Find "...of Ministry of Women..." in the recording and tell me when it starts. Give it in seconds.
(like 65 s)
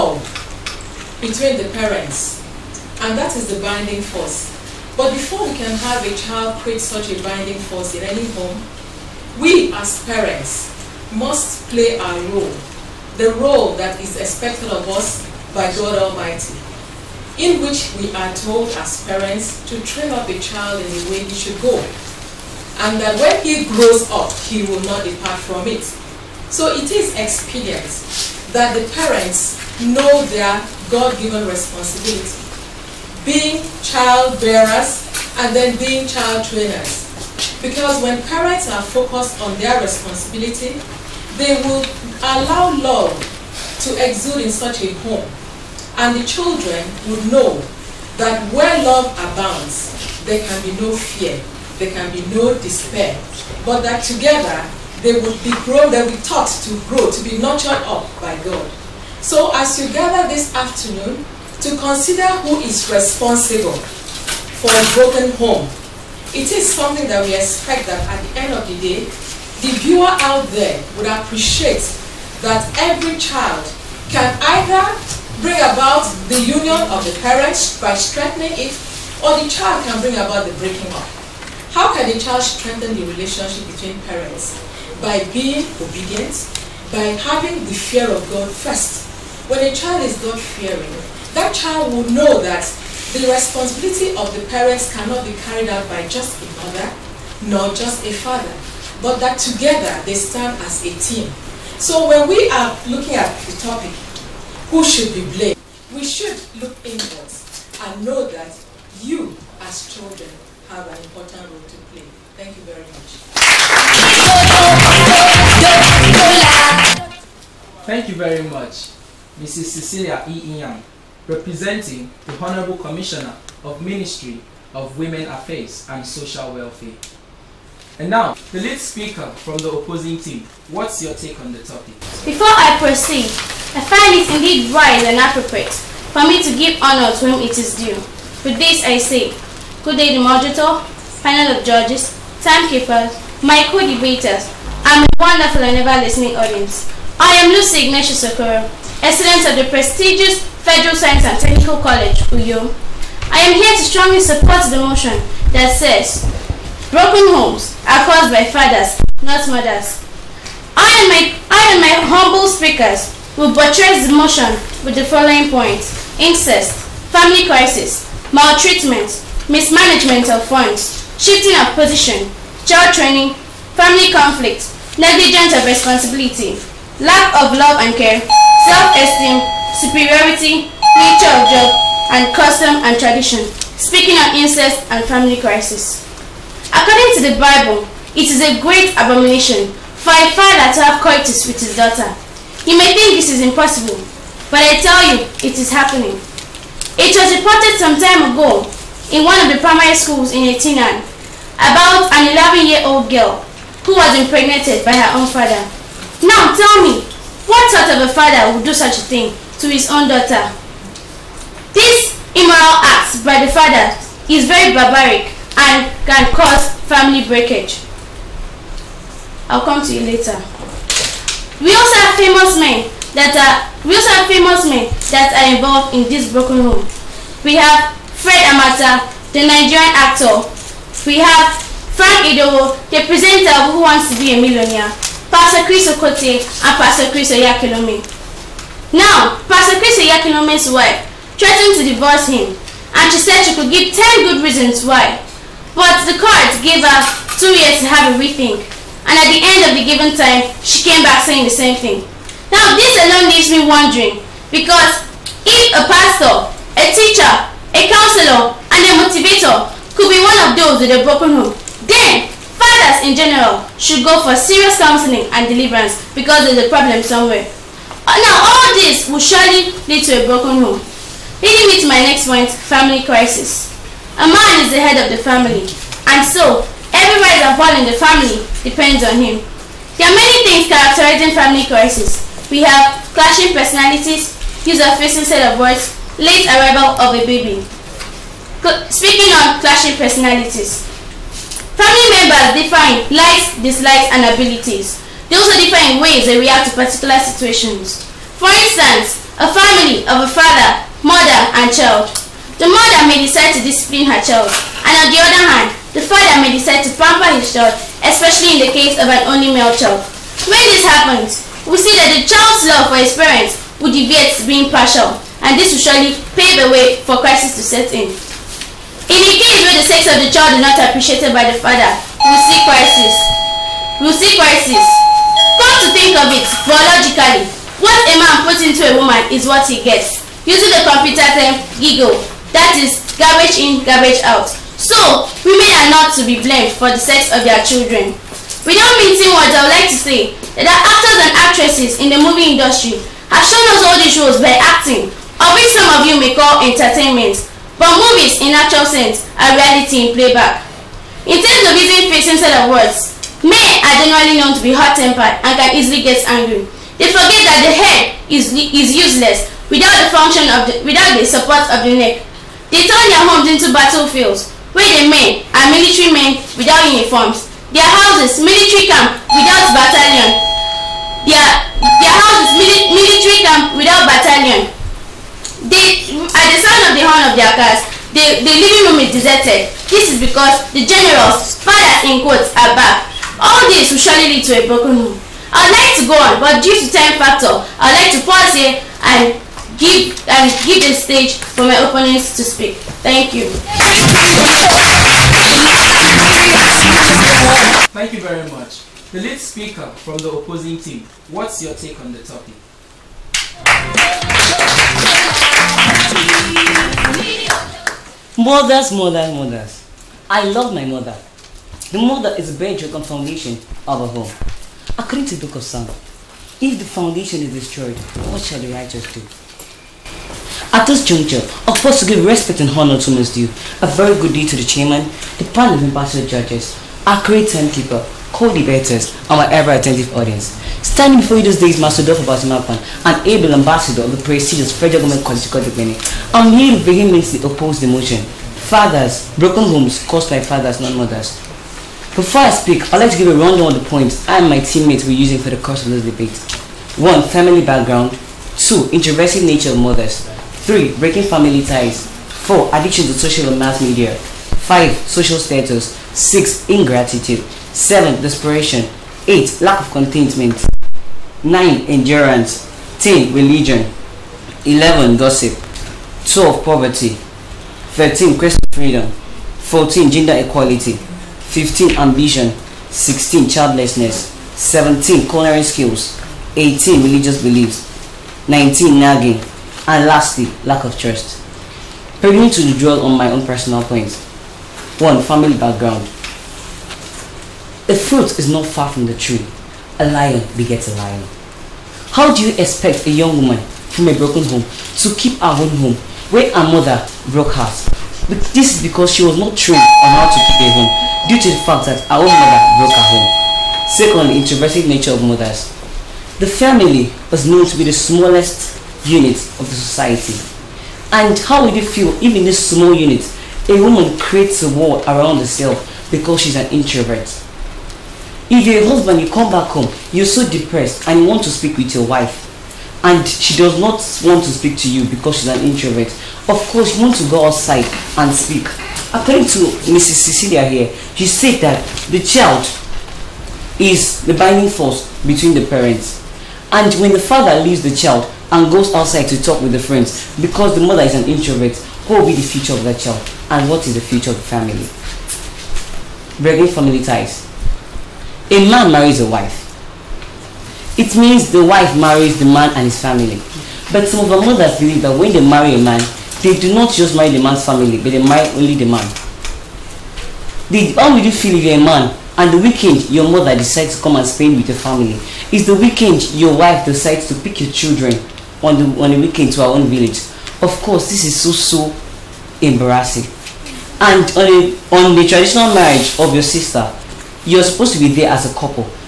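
123 s.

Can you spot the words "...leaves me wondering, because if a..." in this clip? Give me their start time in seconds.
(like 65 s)
253 s.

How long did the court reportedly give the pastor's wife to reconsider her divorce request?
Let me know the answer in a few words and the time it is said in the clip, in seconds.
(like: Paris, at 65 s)
2 years, at 247 s.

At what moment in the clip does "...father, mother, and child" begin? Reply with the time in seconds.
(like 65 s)
300 s.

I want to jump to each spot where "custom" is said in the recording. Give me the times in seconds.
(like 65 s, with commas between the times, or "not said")
182 s.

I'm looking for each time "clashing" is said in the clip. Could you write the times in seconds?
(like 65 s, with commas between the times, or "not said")
283 s, 289 s.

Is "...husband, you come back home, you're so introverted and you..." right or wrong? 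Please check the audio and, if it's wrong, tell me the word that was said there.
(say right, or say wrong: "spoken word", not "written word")
wrong: "depressed", not "introverted".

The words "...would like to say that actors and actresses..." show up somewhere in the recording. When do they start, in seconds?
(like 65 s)
339 s.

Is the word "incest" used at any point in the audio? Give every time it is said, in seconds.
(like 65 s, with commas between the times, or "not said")
166 s, 184 s.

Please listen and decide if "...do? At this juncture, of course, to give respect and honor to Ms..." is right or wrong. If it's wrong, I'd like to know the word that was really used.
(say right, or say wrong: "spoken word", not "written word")
right.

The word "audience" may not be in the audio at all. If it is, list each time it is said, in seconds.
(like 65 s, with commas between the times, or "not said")
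146 s, 430 s.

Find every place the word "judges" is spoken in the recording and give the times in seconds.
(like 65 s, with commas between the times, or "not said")
141 s, 426 s.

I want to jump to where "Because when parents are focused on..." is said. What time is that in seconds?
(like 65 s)
37 s.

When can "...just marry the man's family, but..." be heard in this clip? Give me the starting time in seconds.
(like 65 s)
556 s.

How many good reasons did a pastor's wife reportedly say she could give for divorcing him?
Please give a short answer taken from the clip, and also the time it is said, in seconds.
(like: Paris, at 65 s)
10, at 243 s.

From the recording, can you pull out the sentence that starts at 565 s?
Is the weekend your wife decides to pick your children on the on the weekend to our own village?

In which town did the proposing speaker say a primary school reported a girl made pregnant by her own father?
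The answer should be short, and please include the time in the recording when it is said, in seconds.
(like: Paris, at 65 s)
Etinan, at 200 s.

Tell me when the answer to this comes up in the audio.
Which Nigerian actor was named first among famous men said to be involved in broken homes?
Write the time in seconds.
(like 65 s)
228 s.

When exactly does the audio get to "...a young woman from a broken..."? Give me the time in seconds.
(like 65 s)
493 s.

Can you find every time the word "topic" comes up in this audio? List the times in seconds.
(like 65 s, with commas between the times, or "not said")
103 s, 131 s, 402 s.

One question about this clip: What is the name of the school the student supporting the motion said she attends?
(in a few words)
Federal Science and Technical College.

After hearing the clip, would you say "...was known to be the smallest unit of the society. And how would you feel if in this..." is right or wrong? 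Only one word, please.
right.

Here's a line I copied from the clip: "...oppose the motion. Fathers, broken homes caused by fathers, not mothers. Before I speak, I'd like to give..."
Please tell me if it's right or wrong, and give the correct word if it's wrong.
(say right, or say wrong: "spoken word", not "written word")
right.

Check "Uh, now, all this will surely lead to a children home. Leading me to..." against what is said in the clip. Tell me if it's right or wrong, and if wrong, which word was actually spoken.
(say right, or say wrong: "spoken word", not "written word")
wrong: "broken", not "children".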